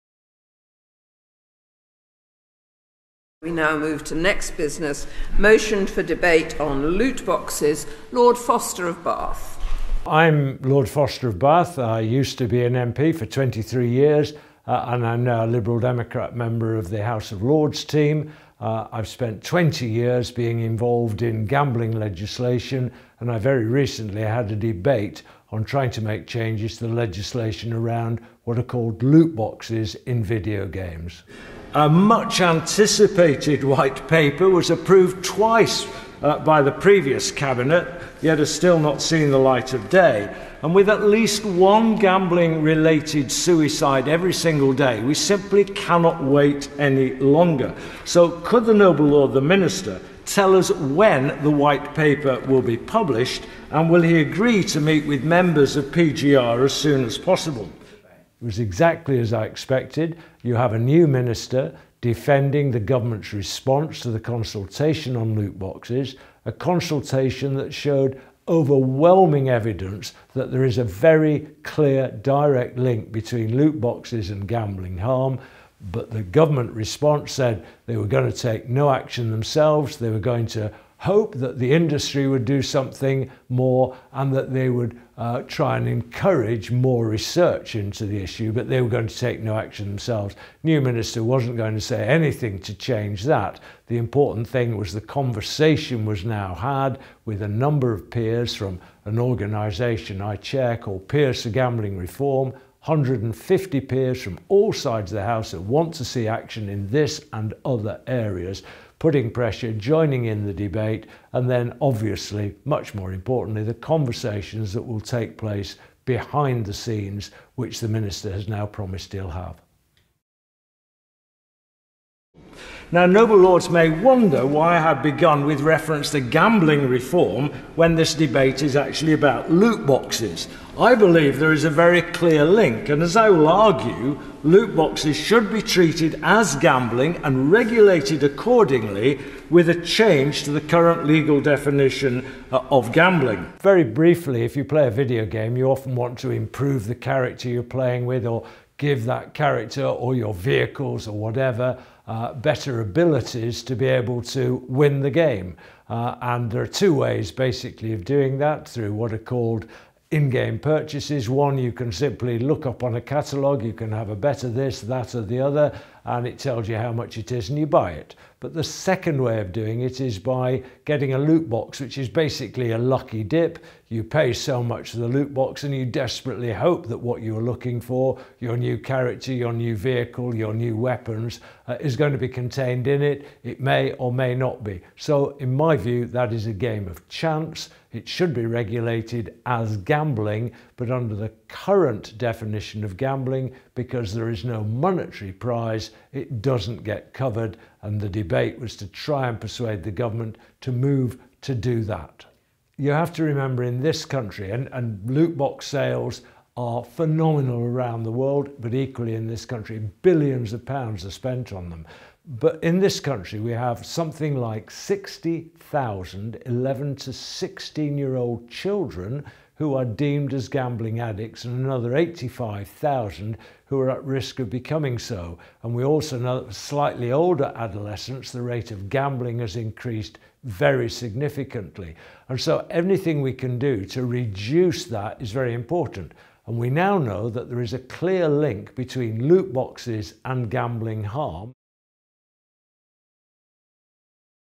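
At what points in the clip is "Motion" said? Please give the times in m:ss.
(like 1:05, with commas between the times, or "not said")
0:05.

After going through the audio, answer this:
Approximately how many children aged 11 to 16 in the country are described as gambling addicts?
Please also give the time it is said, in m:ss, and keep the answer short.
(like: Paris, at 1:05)
60,000, at 3:34.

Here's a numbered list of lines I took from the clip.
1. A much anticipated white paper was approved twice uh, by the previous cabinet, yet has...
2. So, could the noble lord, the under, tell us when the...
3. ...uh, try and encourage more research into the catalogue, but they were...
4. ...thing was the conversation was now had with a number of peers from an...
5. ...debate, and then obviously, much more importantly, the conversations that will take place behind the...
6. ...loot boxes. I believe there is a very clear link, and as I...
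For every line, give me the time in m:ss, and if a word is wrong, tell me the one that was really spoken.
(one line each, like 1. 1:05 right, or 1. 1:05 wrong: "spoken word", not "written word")
1. 0:31 right
2. 0:48 wrong: "minister", not "under"
3. 1:25 wrong: "issue", not "catalogue"
4. 1:34 right
5. 1:50 right
6. 2:09 right.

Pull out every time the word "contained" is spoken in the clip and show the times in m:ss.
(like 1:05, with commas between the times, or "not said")
3:02.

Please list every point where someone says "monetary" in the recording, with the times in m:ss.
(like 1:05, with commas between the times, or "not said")
3:14.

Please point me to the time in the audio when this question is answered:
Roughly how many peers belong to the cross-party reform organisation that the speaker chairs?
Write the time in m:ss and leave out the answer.
1:42.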